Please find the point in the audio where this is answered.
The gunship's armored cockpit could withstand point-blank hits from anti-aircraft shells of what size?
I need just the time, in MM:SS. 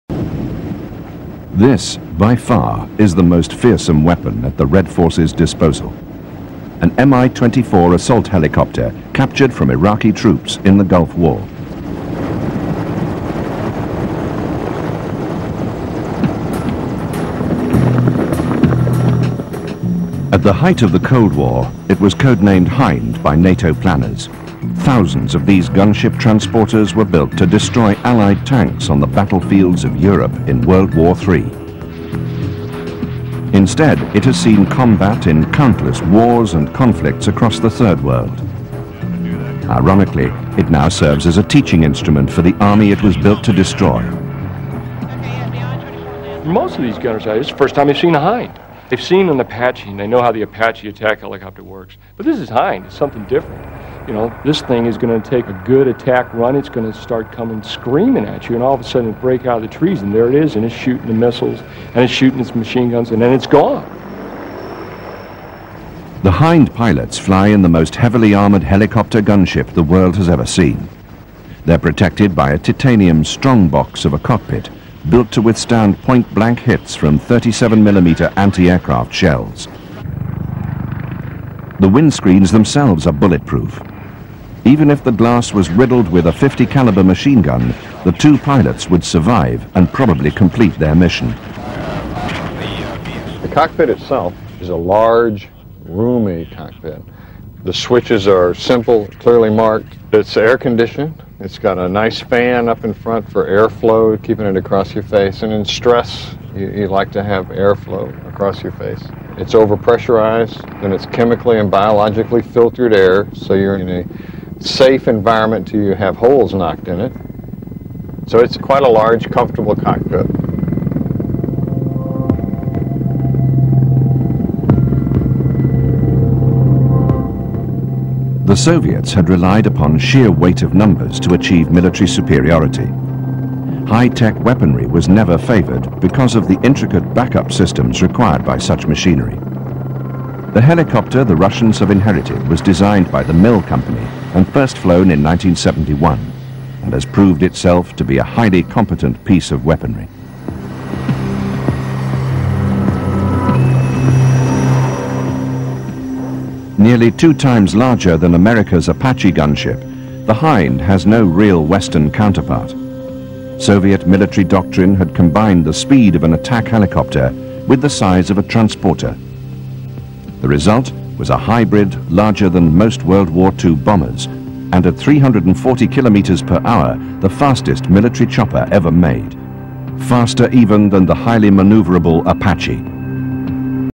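01:17.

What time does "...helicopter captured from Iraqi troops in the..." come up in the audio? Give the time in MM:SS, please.
00:08.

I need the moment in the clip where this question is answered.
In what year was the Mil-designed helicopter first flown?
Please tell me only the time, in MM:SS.
02:25.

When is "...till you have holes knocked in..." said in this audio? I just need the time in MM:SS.
01:55.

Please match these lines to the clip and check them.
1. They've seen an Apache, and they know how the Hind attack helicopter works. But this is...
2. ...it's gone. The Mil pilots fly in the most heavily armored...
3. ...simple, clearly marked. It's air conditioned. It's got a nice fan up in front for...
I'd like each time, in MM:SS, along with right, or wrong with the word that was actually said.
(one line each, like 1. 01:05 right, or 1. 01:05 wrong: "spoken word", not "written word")
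1. 00:48 wrong: "Apache", not "Hind"
2. 01:03 wrong: "Hind", not "Mil"
3. 01:38 right.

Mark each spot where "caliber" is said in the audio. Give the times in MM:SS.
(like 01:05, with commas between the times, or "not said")
01:26.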